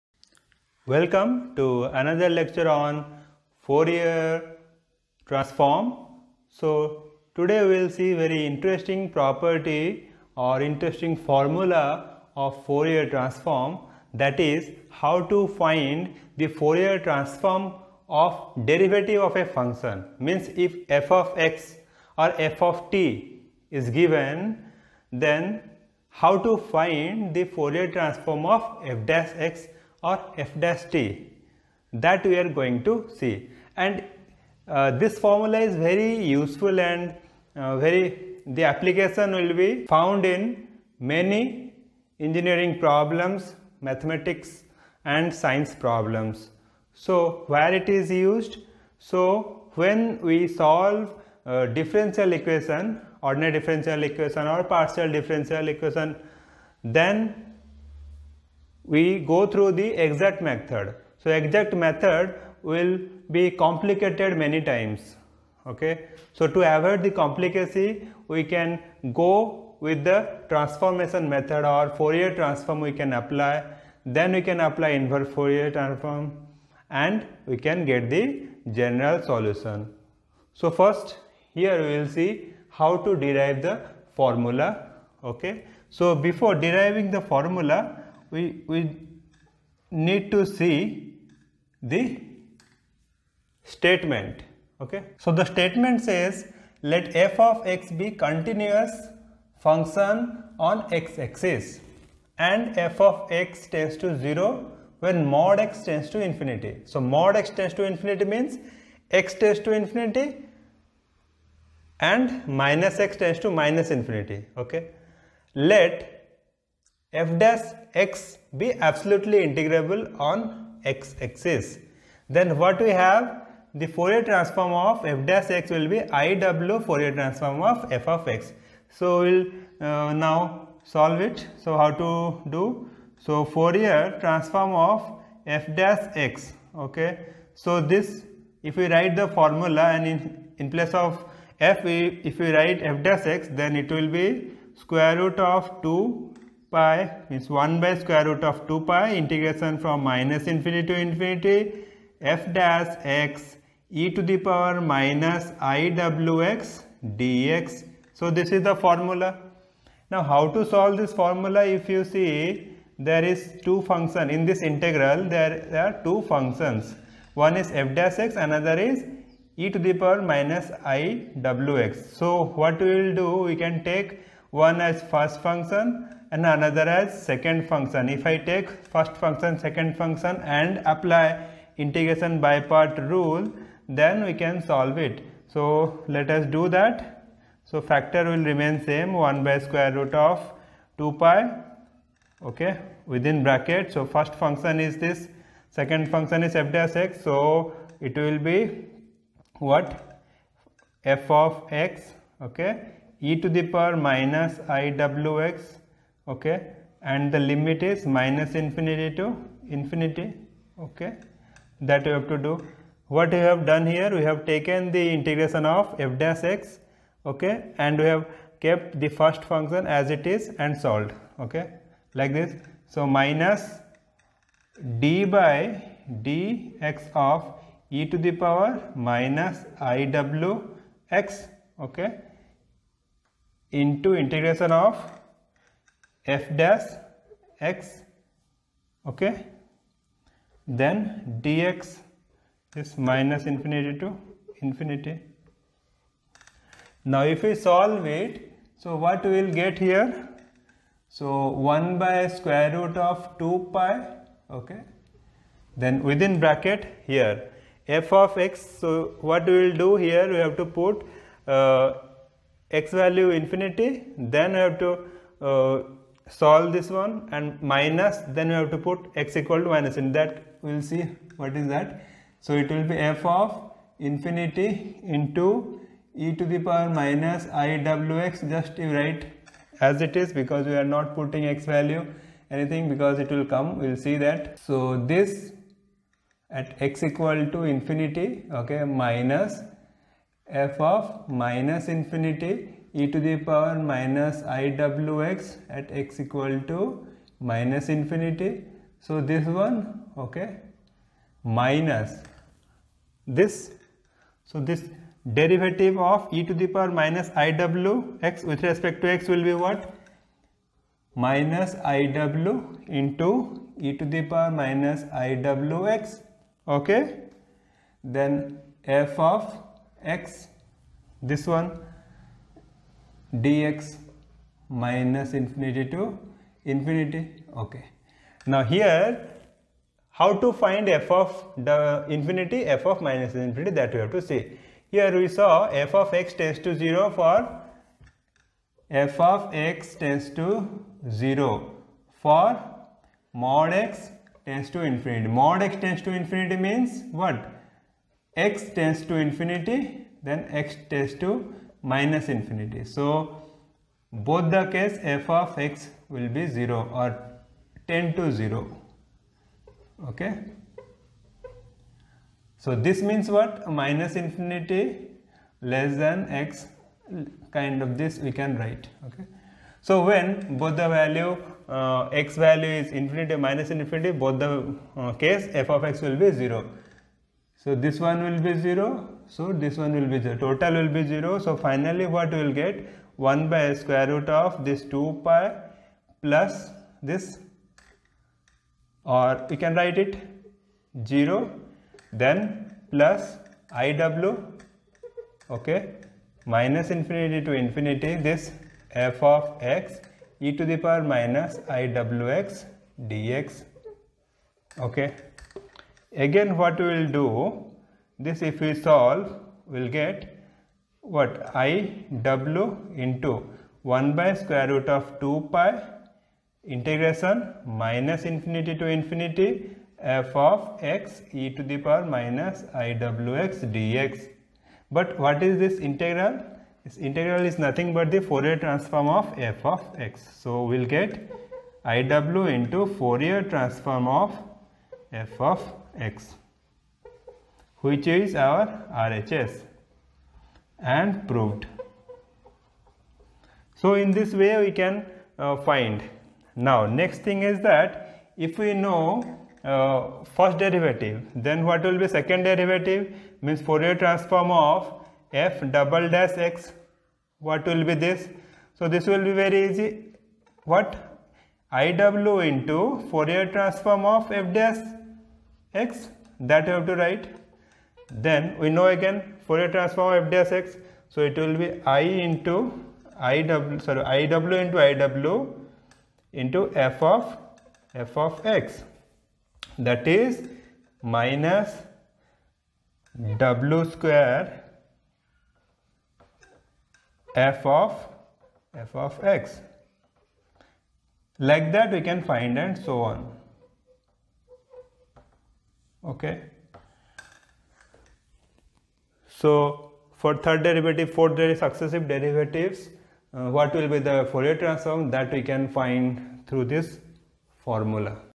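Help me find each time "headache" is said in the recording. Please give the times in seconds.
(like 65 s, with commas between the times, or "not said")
not said.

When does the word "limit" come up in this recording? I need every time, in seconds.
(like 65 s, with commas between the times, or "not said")
207 s.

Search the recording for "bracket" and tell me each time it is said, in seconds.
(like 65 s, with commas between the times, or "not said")
193 s, 256 s.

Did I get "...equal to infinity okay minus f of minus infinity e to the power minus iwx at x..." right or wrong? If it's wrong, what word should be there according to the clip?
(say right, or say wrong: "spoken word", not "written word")
right.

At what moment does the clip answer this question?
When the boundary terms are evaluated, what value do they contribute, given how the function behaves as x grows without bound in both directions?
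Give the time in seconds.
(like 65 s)
380 s.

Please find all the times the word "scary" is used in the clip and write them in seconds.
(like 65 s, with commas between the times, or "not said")
not said.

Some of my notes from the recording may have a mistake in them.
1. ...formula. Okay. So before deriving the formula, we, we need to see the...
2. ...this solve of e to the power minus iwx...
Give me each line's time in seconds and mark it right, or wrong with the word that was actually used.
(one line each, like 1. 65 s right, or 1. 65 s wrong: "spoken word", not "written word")
1. 84 s right
2. 304 s wrong: "derivative", not "solve".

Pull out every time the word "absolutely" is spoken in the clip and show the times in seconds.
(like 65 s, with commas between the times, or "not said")
118 s.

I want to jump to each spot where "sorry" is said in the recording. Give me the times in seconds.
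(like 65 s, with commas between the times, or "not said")
473 s.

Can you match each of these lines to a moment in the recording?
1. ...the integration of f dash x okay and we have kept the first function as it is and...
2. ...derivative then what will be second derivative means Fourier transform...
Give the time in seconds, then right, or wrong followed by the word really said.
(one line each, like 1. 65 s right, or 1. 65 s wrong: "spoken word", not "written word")
1. 214 s right
2. 450 s right.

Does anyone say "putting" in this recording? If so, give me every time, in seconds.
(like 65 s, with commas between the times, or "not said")
281 s.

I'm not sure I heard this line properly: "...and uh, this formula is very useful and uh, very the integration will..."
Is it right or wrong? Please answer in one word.
wrong.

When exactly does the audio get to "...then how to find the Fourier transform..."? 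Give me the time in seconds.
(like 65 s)
25 s.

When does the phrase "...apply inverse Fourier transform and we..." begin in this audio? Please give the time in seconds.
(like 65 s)
74 s.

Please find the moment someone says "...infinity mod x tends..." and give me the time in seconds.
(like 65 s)
344 s.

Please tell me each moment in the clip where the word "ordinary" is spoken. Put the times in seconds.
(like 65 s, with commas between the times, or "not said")
53 s.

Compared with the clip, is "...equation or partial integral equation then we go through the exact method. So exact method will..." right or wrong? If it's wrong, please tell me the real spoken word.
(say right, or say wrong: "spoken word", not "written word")
wrong: "differential", not "integral".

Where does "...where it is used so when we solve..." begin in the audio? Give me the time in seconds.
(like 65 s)
47 s.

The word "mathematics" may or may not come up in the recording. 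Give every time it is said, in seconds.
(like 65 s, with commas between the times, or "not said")
43 s.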